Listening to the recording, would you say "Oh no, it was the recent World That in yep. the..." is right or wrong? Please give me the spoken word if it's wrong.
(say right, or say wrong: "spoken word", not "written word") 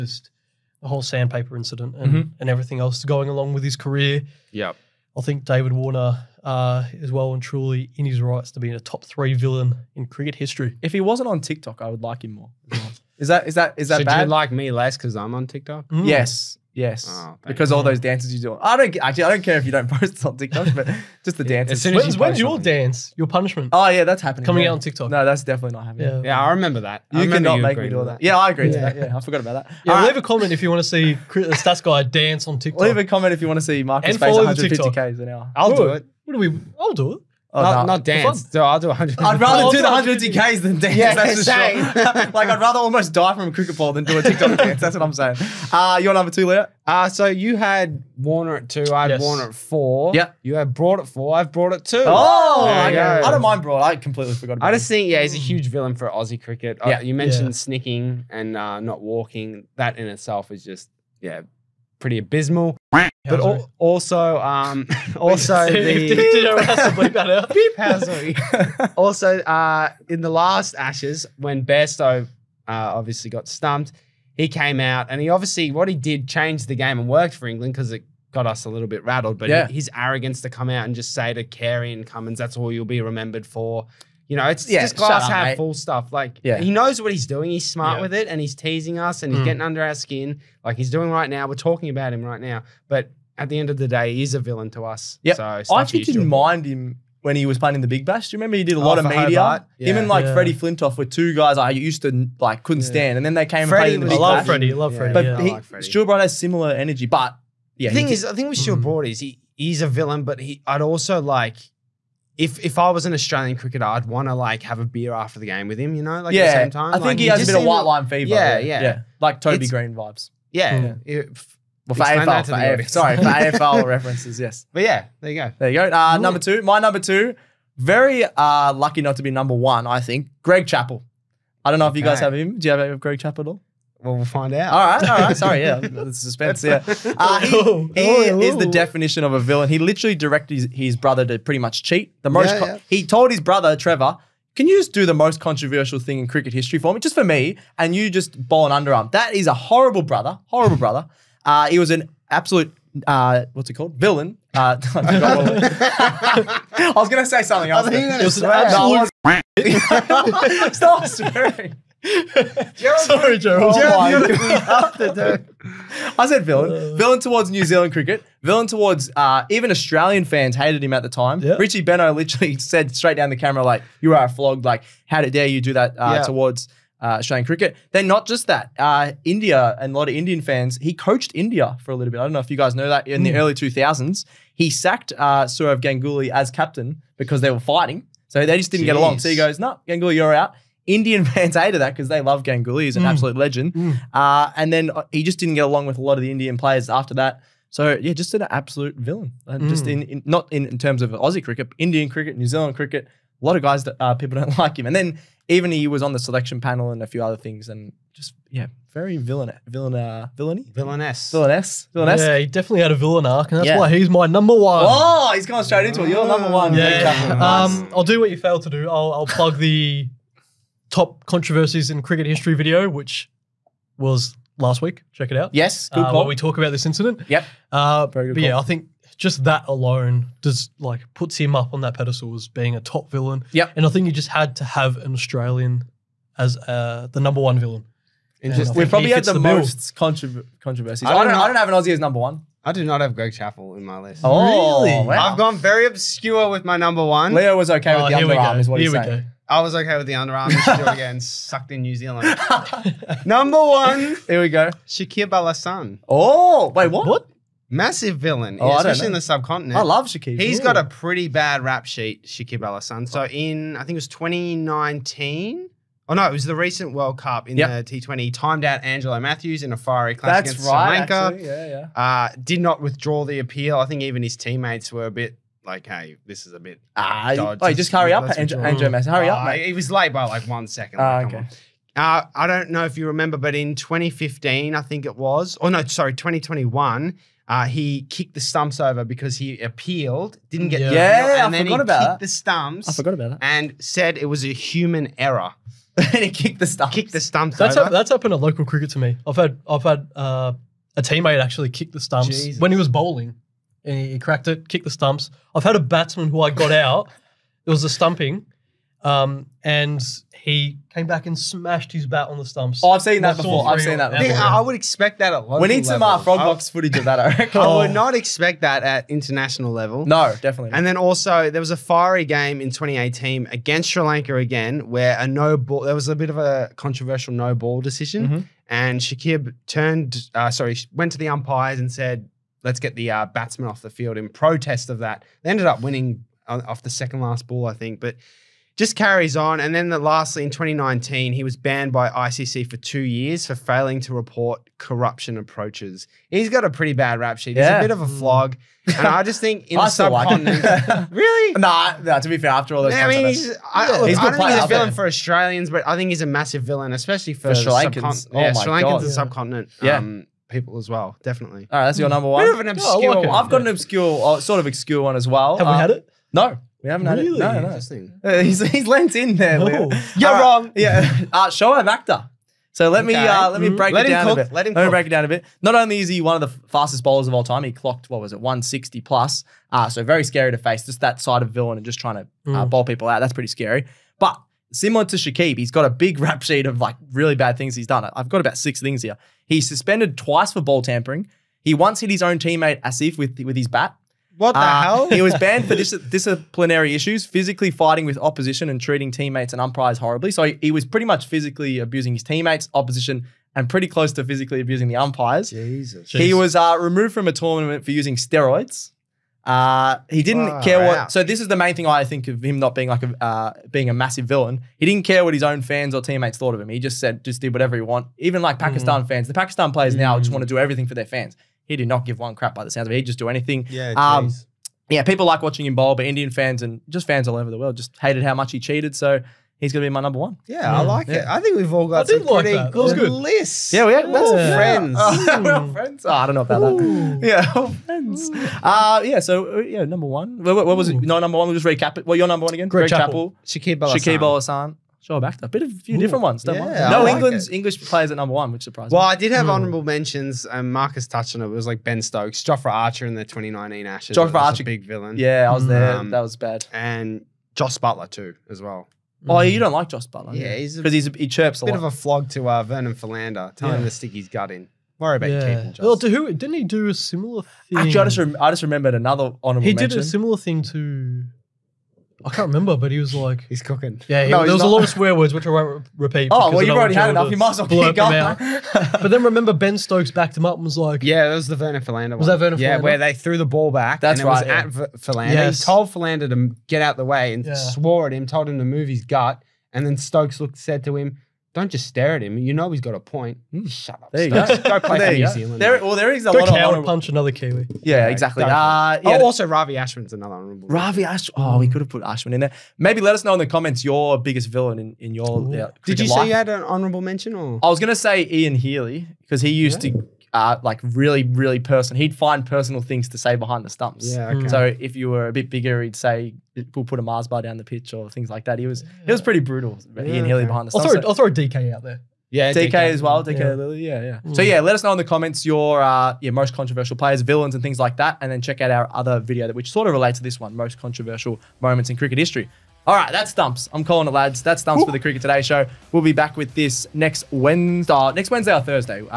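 wrong: "Cup", not "That".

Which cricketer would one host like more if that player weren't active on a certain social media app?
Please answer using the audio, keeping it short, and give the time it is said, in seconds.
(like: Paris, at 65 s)
David Warner, at 5 s.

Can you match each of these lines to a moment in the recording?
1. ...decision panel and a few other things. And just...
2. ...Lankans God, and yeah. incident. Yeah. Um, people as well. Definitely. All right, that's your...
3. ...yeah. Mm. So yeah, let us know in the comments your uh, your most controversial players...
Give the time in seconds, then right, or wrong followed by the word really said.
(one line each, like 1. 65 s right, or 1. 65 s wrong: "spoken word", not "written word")
1. 206 s wrong: "selection", not "decision"
2. 358 s wrong: "subcontinent", not "incident"
3. 524 s right.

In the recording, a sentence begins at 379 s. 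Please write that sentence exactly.
Uh, so very scary to face.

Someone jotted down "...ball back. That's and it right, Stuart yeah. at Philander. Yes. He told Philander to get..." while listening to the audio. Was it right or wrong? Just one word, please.
wrong.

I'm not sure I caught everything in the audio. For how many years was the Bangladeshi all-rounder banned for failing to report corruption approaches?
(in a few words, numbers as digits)
2.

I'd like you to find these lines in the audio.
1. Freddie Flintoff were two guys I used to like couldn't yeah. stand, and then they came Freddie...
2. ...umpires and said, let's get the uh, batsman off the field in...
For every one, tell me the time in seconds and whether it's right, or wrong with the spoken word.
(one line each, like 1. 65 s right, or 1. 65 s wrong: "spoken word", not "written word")
1. 100 s right
2. 331 s right.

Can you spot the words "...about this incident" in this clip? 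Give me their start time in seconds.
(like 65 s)
226 s.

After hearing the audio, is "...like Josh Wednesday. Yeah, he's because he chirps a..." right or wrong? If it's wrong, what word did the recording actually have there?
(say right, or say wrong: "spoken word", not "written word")
wrong: "Buttler", not "Wednesday".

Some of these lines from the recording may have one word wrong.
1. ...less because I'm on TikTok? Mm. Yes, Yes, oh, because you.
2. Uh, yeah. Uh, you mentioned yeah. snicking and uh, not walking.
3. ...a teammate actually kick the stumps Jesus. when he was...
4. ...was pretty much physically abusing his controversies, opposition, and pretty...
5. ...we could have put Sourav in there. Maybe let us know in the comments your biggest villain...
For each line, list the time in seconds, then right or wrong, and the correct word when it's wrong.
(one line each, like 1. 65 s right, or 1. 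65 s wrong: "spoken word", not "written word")
1. 14 s right
2. 56 s right
3. 300 s right
4. 400 s wrong: "teammates", not "controversies"
5. 501 s wrong: "Ashwin", not "Sourav".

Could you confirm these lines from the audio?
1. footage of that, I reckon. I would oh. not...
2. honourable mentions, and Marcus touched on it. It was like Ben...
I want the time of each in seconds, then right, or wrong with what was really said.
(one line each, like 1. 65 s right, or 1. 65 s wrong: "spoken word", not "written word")
1. 316 s right
2. 449 s right.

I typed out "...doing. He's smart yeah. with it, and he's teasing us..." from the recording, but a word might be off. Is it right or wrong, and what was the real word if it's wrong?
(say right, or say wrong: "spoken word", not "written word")
right.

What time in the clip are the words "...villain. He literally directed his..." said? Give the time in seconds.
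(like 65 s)
139 s.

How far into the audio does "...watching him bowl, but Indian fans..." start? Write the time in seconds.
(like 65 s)
425 s.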